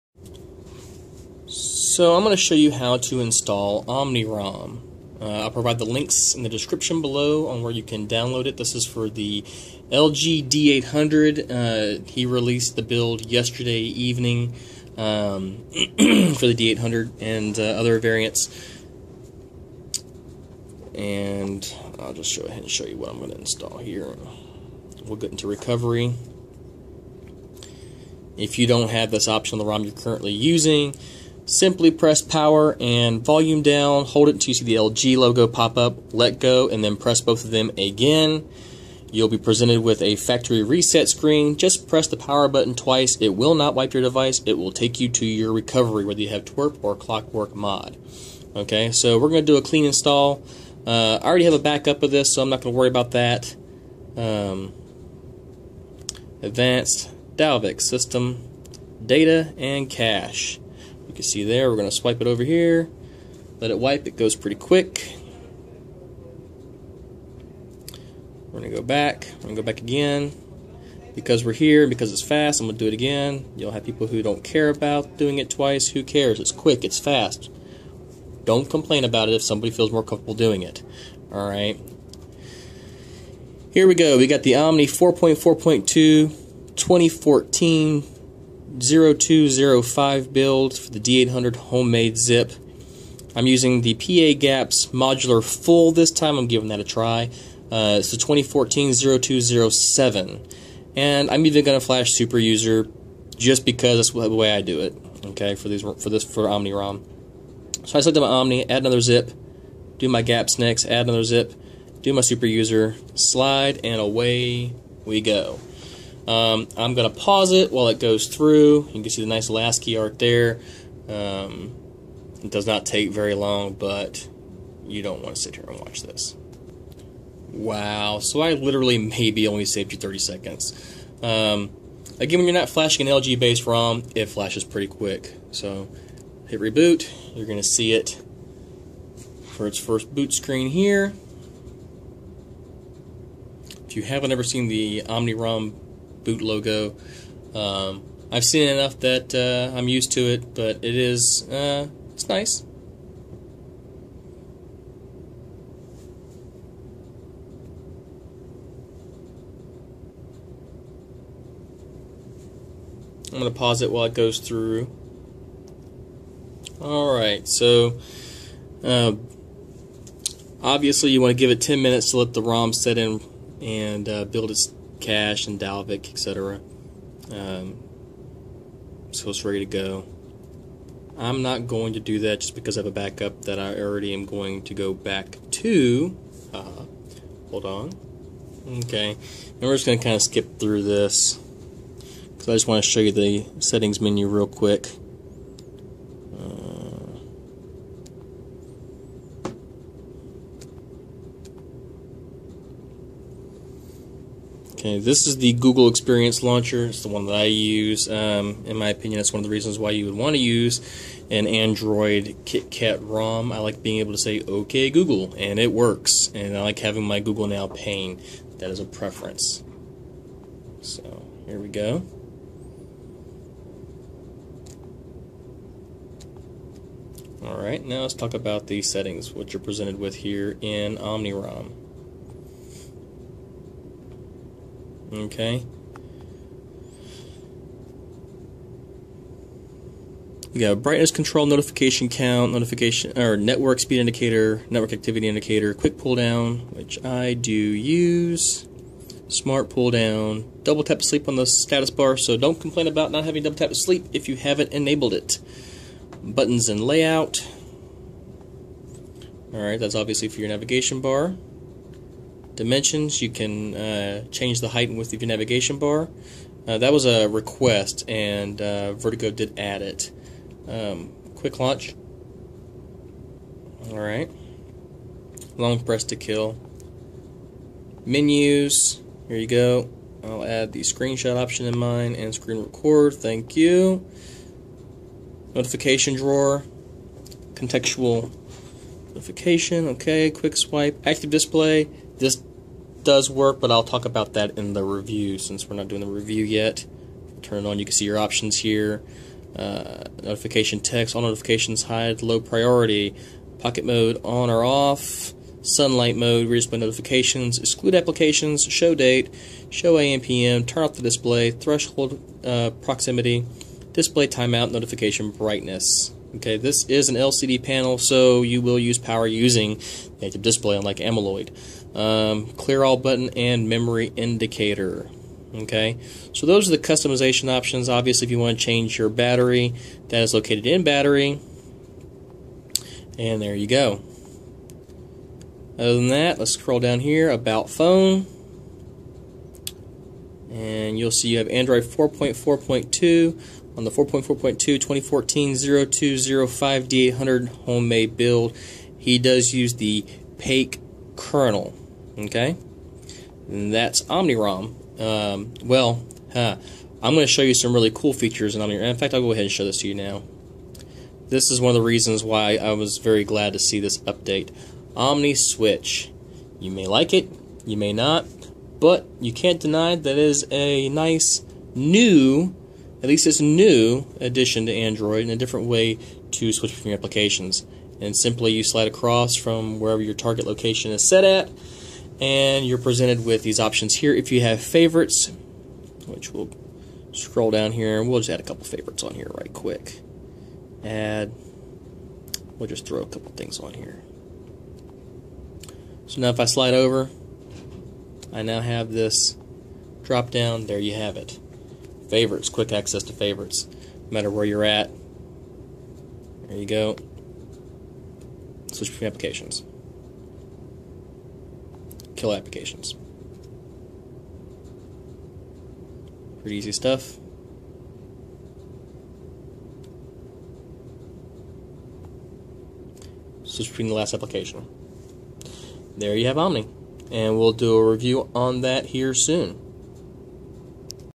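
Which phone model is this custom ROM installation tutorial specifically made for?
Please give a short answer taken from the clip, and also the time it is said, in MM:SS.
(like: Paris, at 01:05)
LG D800, at 00:09.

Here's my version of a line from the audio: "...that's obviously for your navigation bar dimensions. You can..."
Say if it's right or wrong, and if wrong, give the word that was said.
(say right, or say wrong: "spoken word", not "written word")
right.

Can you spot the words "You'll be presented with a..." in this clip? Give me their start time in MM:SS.
00:39.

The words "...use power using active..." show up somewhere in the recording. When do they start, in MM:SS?
05:18.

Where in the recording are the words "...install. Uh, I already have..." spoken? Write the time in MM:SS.
00:49.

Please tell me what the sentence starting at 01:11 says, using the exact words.
Because we're here, because it's fast, I'm going to do it again.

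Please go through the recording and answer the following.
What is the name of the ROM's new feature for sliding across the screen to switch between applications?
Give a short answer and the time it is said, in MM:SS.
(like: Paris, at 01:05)
Omni Switch, at 06:04.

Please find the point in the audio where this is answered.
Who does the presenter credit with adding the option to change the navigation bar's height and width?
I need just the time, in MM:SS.
04:28.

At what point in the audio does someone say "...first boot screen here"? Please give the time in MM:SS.
02:19.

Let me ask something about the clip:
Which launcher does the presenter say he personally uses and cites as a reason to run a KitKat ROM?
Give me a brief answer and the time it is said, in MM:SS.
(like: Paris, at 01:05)
Google Experience Launcher, at 03:25.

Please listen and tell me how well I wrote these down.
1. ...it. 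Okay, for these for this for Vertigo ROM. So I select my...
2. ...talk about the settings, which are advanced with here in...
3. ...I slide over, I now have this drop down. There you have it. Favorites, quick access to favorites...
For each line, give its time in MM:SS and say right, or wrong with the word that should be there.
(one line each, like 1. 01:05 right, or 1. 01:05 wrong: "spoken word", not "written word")
1. 01:44 wrong: "Omni", not "Vertigo"
2. 03:48 wrong: "presented", not "advanced"
3. 06:36 right.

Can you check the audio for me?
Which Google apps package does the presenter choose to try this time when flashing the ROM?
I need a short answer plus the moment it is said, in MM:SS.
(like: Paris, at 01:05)
PA GApps modular full, at 01:33.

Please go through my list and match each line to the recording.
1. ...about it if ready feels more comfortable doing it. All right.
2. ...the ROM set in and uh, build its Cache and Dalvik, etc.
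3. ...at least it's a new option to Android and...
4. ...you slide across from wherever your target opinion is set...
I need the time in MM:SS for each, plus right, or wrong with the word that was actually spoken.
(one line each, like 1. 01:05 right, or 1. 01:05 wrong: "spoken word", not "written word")
1. 01:19 wrong: "somebody", not "ready"
2. 02:52 right
3. 06:13 wrong: "addition", not "option"
4. 06:18 wrong: "location", not "opinion".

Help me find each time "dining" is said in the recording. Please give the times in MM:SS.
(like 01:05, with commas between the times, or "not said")
not said.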